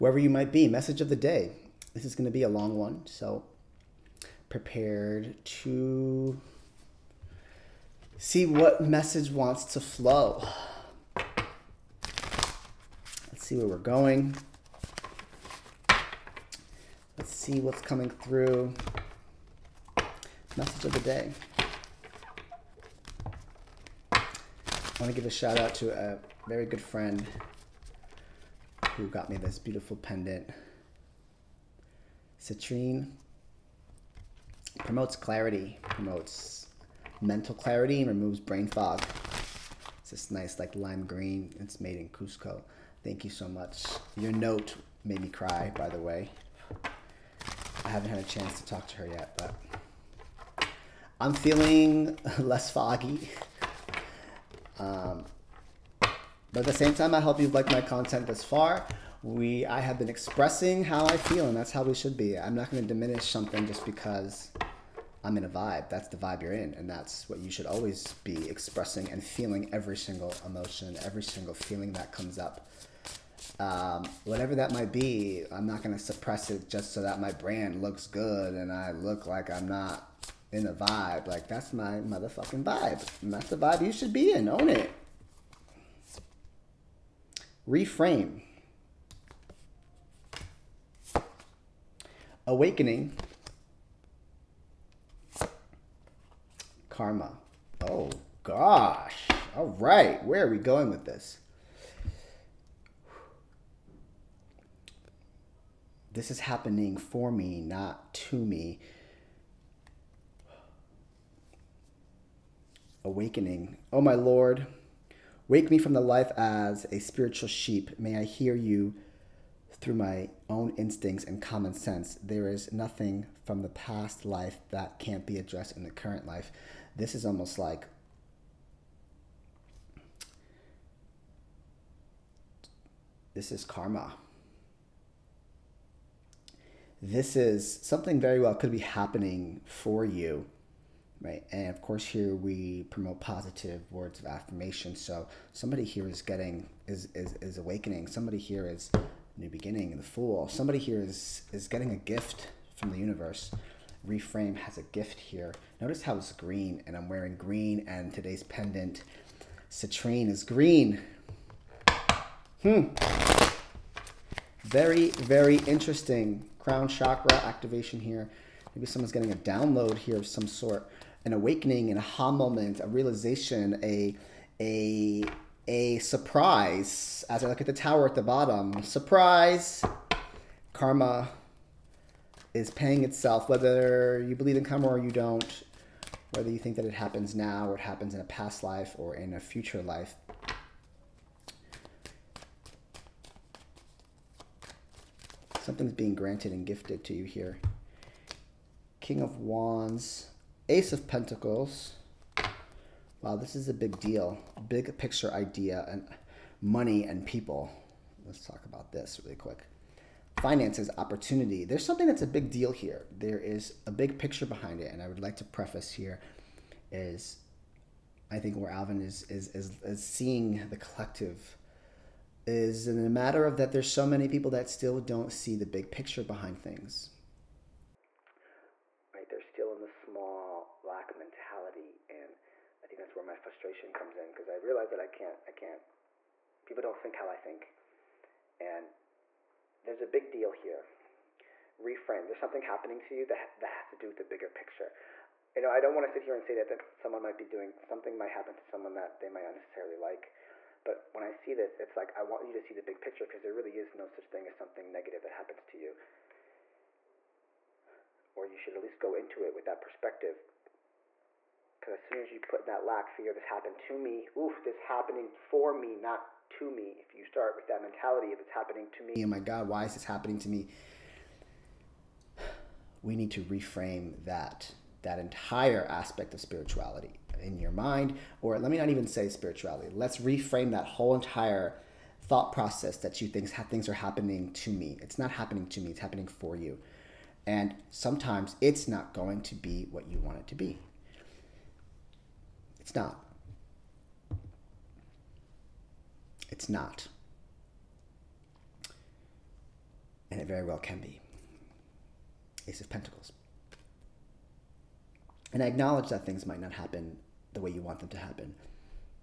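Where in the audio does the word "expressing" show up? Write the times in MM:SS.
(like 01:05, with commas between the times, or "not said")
01:00, 01:08.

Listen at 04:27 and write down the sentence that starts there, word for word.
If you start with that mentality of it's happening to me, oh my God, why is this happening to me?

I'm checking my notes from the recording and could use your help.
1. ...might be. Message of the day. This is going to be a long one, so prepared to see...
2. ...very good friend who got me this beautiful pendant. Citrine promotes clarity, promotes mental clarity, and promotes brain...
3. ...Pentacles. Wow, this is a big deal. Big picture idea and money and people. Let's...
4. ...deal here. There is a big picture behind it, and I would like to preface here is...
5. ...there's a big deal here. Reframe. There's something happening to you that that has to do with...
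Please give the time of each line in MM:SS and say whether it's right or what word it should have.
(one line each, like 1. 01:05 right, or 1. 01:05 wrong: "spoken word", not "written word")
1. 00:00 right
2. 00:26 wrong: "removes", not "promotes"
3. 03:21 right
4. 03:32 right
5. 03:59 right.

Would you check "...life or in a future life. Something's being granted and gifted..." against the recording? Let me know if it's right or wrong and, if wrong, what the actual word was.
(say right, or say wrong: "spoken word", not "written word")
right.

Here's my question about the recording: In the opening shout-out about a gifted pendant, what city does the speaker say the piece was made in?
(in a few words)
Cusco.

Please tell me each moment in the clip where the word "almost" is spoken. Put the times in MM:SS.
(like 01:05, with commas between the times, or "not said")
02:07.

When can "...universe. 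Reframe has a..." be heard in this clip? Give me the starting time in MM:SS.
02:32.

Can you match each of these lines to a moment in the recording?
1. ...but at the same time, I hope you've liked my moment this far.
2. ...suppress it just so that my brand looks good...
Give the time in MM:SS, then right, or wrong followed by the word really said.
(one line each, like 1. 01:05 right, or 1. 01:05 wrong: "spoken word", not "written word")
1. 00:56 wrong: "content", not "moment"
2. 01:15 right.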